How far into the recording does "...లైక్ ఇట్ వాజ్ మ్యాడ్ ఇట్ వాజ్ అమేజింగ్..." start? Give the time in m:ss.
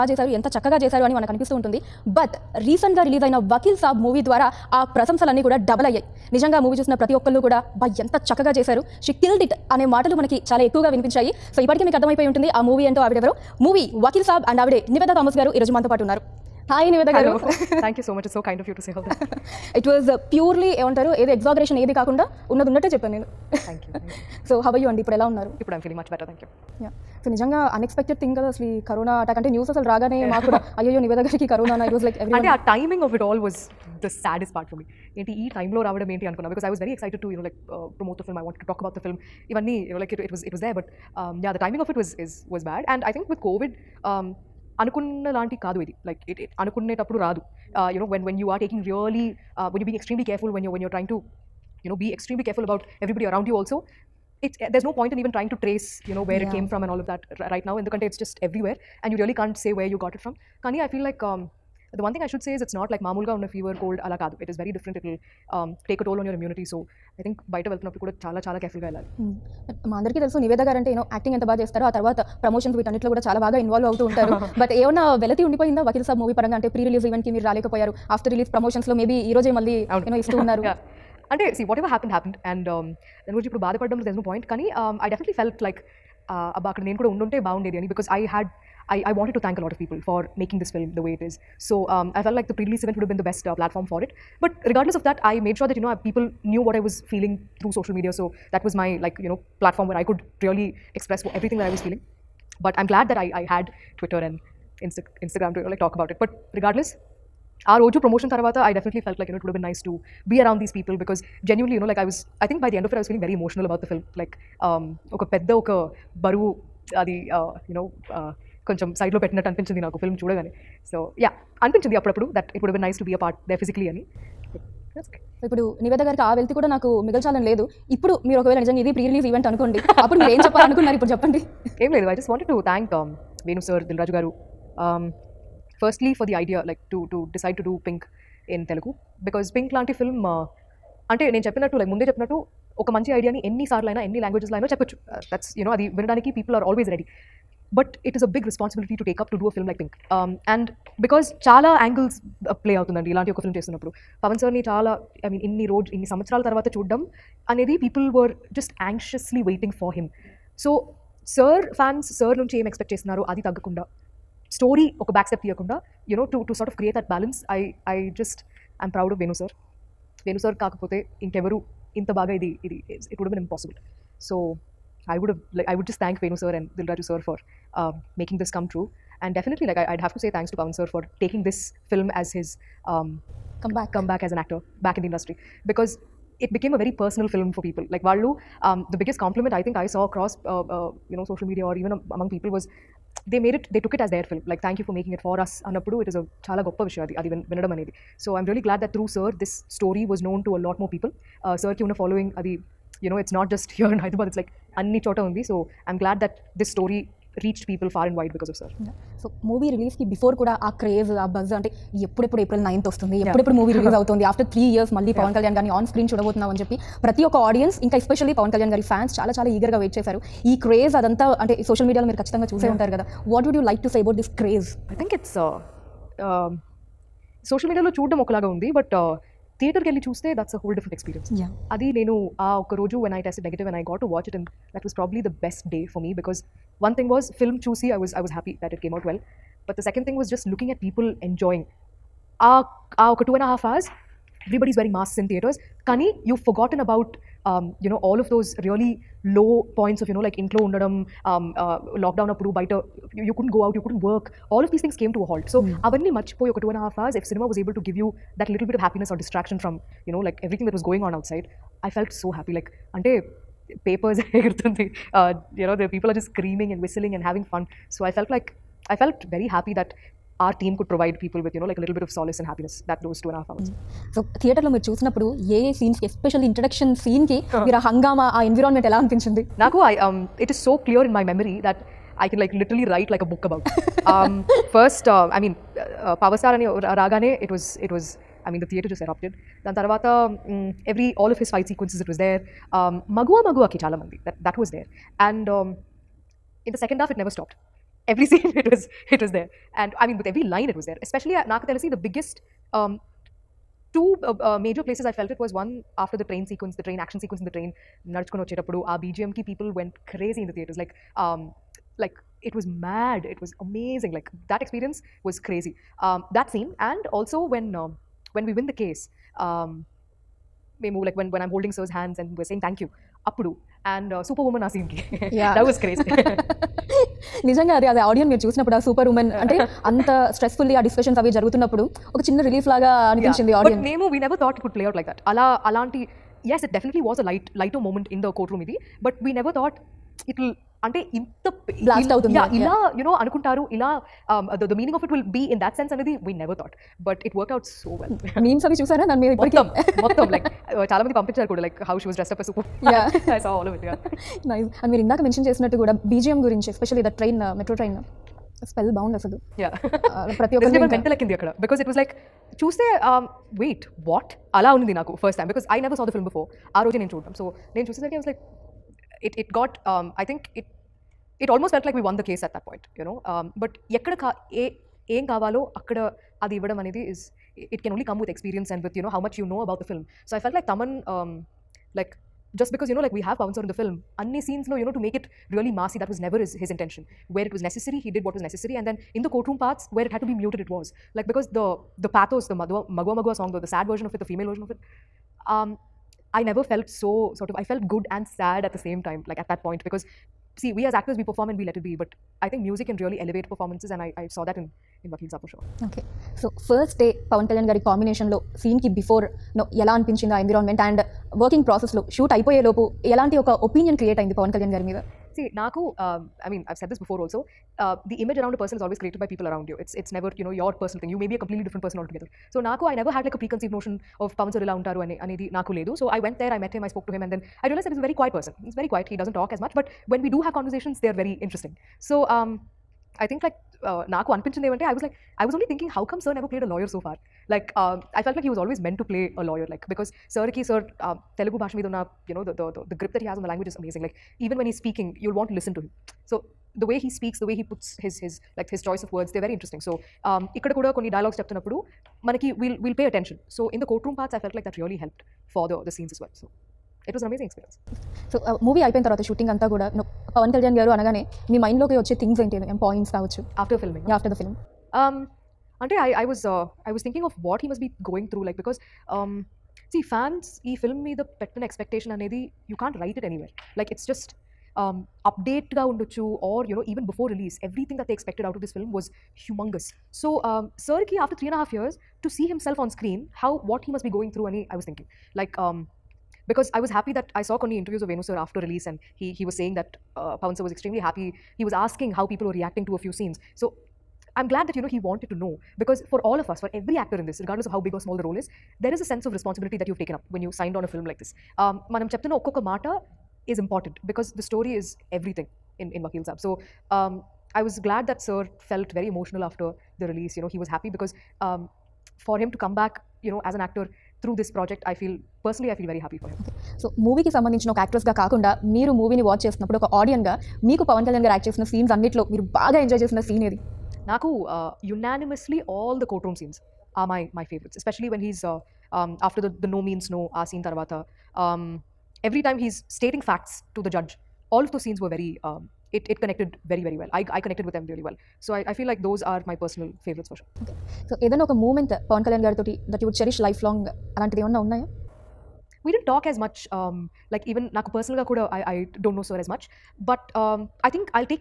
5:12.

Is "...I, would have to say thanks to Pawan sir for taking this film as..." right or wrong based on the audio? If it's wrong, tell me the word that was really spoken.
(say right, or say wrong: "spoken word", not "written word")
right.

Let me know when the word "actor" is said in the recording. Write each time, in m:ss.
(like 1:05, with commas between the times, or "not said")
3:04, 6:40, 8:17, 8:33.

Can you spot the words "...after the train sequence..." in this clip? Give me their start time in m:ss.
5:05.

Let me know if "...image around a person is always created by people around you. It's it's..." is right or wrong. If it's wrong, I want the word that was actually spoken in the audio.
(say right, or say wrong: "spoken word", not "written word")
right.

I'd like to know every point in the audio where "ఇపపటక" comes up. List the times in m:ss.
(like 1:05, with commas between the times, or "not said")
0:11, 5:49.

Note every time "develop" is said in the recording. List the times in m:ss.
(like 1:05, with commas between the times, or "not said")
not said.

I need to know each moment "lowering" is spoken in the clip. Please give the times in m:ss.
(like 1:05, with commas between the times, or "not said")
not said.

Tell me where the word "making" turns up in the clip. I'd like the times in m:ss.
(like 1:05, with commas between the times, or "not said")
2:58, 3:14.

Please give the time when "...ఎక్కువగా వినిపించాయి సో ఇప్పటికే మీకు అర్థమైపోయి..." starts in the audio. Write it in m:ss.
0:10.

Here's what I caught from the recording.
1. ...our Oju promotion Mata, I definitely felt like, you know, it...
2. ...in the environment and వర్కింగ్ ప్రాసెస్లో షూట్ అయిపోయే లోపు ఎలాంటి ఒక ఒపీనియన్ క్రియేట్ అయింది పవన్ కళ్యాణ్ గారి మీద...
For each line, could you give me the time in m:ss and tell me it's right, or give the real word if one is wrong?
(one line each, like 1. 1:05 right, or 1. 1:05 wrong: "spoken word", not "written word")
1. 1:47 wrong: "Taravata", not "Mata"
2. 6:50 right.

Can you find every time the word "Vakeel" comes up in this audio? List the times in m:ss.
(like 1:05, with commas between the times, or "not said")
6:45, 8:26.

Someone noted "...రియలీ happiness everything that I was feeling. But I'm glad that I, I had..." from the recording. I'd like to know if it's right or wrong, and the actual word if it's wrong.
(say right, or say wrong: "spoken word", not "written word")
wrong: "express", not "happiness".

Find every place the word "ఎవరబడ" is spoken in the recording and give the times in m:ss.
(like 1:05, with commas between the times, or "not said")
0:53, 4:04.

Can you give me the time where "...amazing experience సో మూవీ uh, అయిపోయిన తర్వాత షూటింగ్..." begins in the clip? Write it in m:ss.
7:37.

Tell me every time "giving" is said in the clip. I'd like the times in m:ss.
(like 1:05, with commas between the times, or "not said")
not said.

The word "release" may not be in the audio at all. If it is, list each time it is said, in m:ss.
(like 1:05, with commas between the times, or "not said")
8:08, 8:30.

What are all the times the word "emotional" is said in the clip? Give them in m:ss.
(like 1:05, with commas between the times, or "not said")
1:53, 8:29.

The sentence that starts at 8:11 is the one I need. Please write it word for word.
He was asking how people were reacting to a few scenes.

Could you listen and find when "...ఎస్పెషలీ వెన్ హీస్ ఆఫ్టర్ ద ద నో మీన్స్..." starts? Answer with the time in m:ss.
8:47.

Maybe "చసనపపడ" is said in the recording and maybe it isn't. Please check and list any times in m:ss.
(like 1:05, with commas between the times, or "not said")
4:34, 5:28.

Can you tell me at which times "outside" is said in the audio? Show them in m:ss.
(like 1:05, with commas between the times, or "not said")
4:21.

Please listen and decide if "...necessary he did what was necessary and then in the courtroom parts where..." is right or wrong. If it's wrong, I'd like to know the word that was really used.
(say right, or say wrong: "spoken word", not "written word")
right.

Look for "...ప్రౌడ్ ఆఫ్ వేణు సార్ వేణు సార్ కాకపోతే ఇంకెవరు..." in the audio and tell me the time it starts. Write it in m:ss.
2:48.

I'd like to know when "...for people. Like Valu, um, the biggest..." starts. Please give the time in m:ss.
3:07.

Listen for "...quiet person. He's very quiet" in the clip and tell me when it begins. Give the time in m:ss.
7:08.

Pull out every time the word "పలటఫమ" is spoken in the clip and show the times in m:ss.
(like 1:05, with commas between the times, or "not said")
1:33, 1:39.